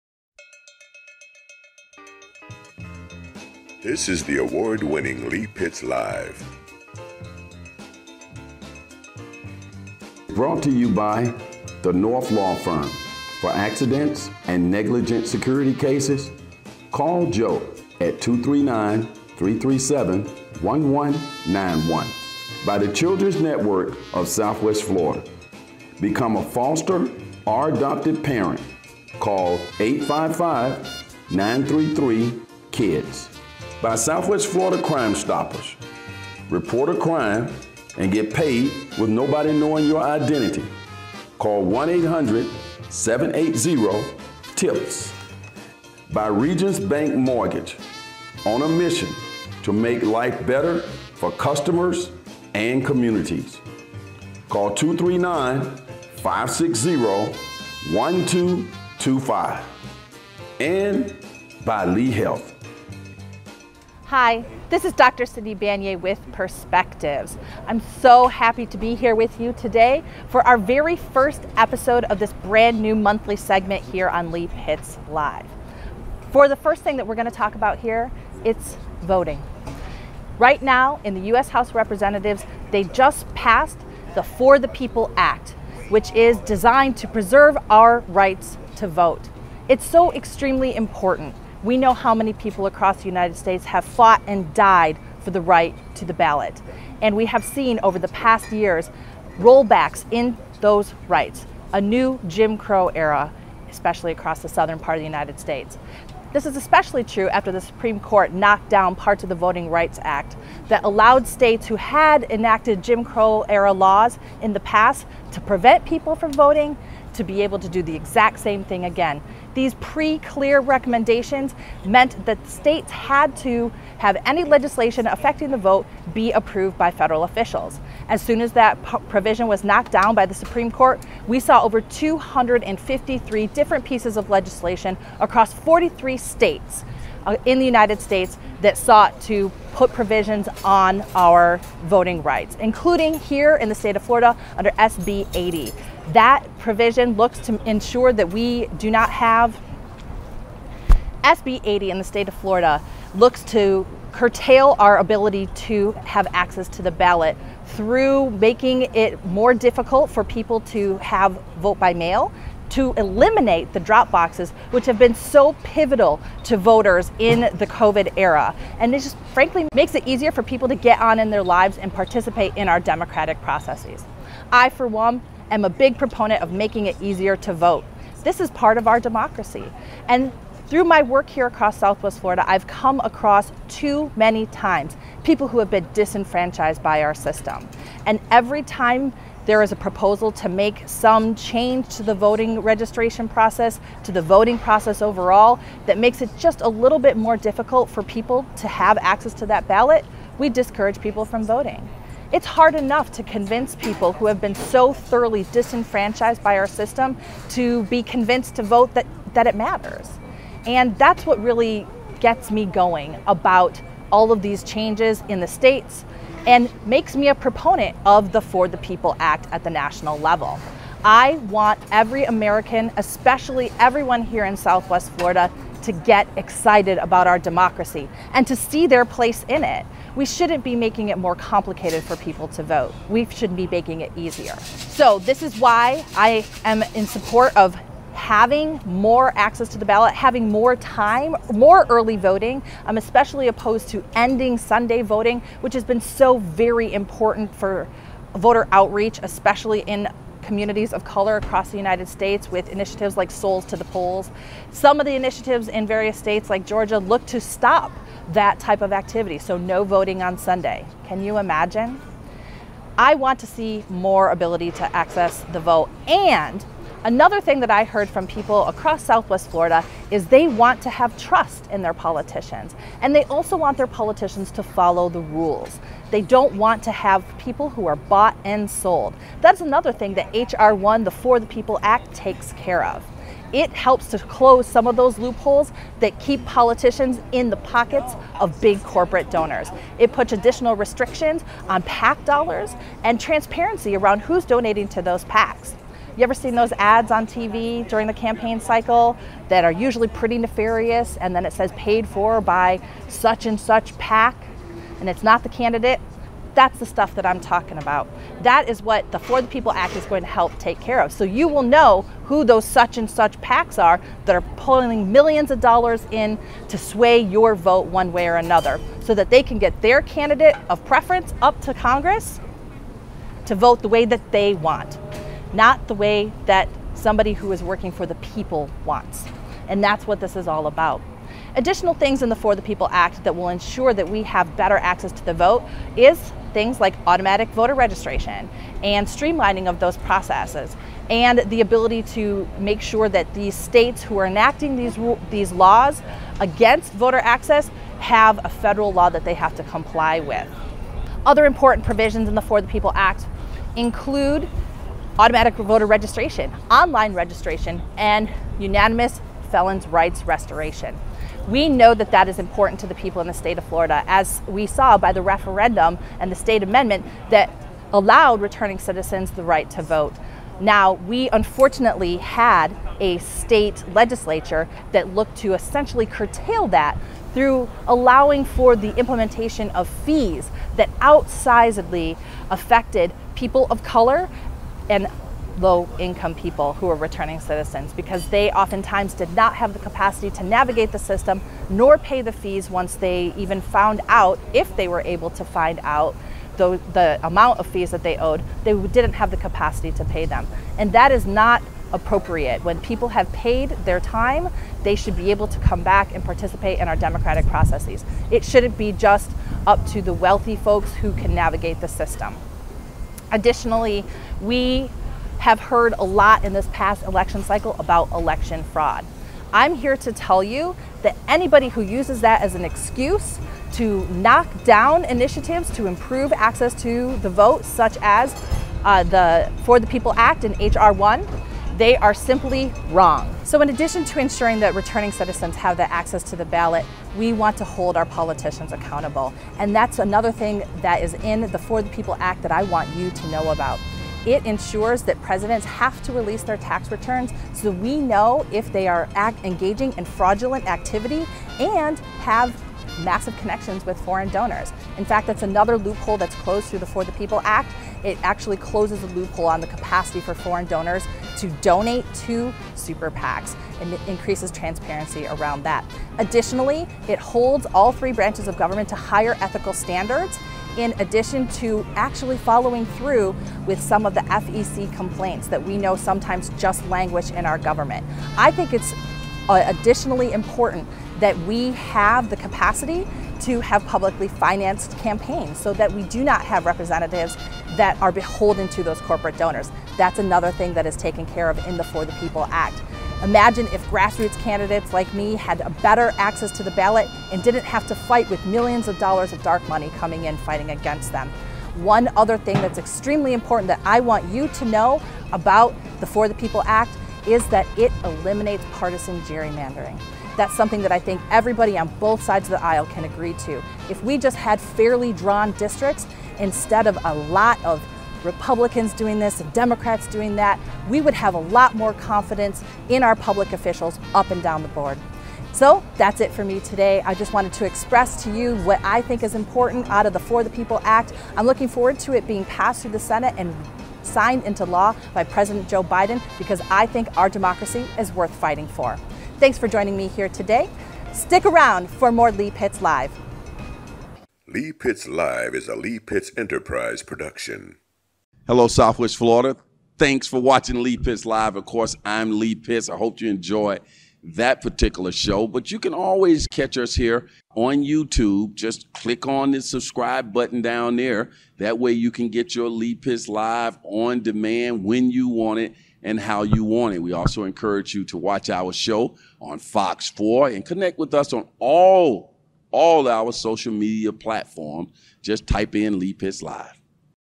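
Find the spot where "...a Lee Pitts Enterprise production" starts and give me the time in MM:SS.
09:05.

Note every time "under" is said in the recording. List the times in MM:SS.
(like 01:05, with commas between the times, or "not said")
02:24.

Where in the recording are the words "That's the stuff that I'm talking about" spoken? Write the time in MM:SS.
05:06.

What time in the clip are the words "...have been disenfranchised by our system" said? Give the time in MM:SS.
03:05.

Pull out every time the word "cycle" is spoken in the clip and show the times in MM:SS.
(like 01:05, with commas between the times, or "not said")
04:58, 06:57.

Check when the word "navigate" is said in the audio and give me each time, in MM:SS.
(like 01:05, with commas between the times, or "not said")
06:30, 06:51.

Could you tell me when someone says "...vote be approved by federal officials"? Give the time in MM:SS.
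02:05.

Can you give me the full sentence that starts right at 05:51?
Other important provisions in the For the People Act include automatic voter registration, online registration, and unanimous felons' rights restoration.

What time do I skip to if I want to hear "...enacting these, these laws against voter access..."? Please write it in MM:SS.
05:44.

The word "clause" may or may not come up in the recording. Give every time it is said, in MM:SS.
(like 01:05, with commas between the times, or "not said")
not said.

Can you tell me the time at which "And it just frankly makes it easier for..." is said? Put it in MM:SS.
02:48.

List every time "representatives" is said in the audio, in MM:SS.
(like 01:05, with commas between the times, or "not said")
01:21, 08:06.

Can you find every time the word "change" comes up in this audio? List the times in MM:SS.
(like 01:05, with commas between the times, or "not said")
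03:11, 03:34.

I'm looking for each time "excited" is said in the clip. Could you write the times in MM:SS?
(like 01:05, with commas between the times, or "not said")
03:46.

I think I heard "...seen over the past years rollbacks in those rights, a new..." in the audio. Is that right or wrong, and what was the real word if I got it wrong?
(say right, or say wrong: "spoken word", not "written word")
right.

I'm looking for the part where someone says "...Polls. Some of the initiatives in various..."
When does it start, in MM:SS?
04:13.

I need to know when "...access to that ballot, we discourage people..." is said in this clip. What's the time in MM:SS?
03:18.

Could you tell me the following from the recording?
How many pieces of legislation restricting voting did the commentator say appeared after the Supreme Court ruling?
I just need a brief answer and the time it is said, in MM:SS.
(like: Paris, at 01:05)
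253, at 02:11.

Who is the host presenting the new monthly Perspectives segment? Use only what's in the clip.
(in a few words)
Cindy Banyai.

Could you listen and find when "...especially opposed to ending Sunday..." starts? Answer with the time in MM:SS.
04:02.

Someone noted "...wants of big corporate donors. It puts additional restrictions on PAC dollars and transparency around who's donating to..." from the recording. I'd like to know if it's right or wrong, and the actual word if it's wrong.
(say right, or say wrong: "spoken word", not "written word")
wrong: "pockets", not "wants".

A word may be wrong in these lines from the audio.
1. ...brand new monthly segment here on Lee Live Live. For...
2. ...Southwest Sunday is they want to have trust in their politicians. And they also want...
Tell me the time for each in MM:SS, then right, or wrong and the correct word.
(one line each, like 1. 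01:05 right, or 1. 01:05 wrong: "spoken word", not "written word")
1. 01:12 wrong: "Pitts", not "Live"
2. 04:29 wrong: "Florida", not "Sunday".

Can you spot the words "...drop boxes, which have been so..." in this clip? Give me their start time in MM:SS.
02:43.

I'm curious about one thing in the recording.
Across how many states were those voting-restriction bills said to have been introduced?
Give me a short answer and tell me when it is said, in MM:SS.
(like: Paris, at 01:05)
43, at 02:15.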